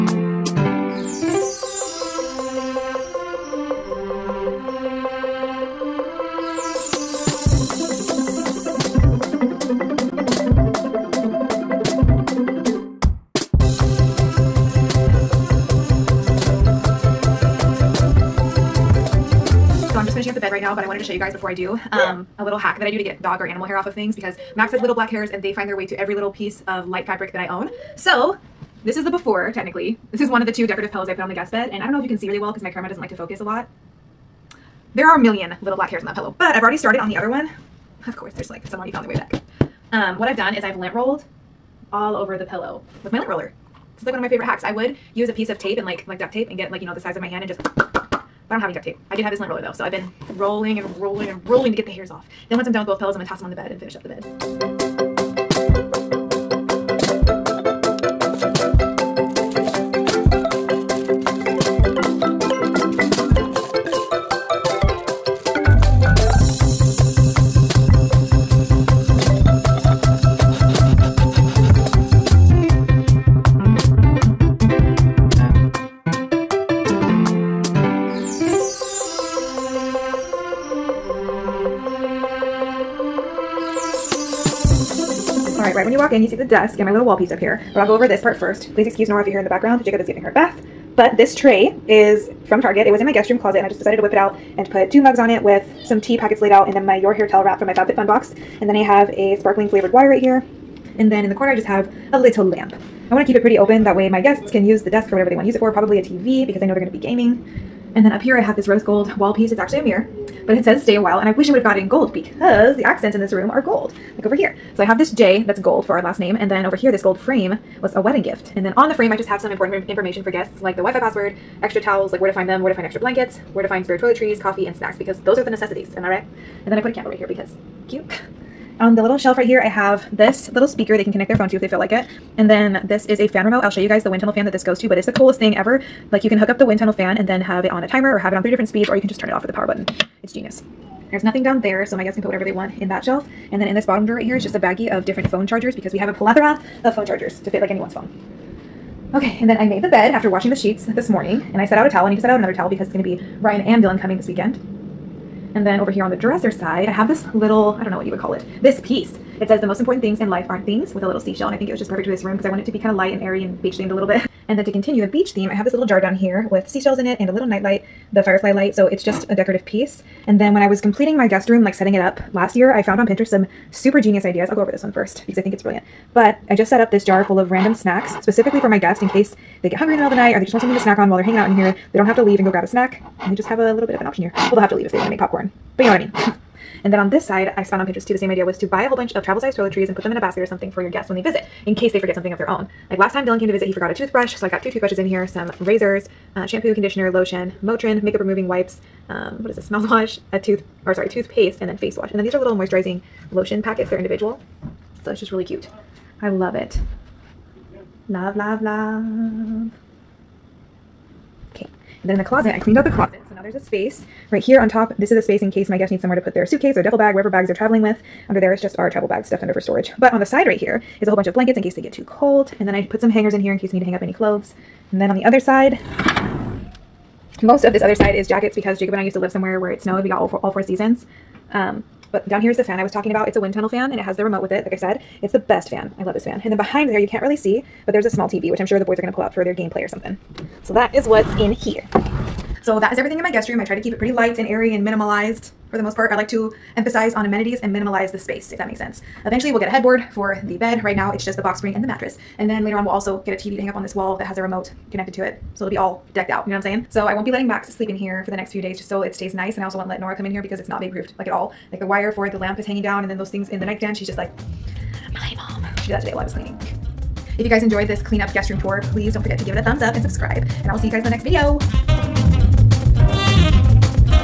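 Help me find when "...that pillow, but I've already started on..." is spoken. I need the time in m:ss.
0:36.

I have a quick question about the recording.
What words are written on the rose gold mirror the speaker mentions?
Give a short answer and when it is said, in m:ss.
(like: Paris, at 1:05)
stay a while, at 1:50.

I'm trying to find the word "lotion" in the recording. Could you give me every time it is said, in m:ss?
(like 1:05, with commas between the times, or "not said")
3:17, 3:23.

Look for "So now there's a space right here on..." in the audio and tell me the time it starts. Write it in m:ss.
3:33.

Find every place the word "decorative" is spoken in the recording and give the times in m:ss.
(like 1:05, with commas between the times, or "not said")
0:30, 2:49.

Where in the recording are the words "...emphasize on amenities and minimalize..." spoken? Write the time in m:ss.
4:06.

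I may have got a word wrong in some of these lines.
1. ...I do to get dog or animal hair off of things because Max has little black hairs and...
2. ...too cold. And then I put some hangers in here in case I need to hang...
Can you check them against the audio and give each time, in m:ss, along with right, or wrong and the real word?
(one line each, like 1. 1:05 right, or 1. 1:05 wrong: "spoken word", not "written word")
1. 0:22 right
2. 3:41 right.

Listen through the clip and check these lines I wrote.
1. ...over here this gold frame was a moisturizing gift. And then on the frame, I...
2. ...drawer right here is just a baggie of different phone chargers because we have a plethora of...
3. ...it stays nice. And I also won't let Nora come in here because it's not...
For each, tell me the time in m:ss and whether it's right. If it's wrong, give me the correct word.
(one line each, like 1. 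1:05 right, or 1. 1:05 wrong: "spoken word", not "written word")
1. 1:56 wrong: "wedding", not "moisturizing"
2. 2:24 right
3. 4:19 right.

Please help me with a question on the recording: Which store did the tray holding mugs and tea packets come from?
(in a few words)
Target.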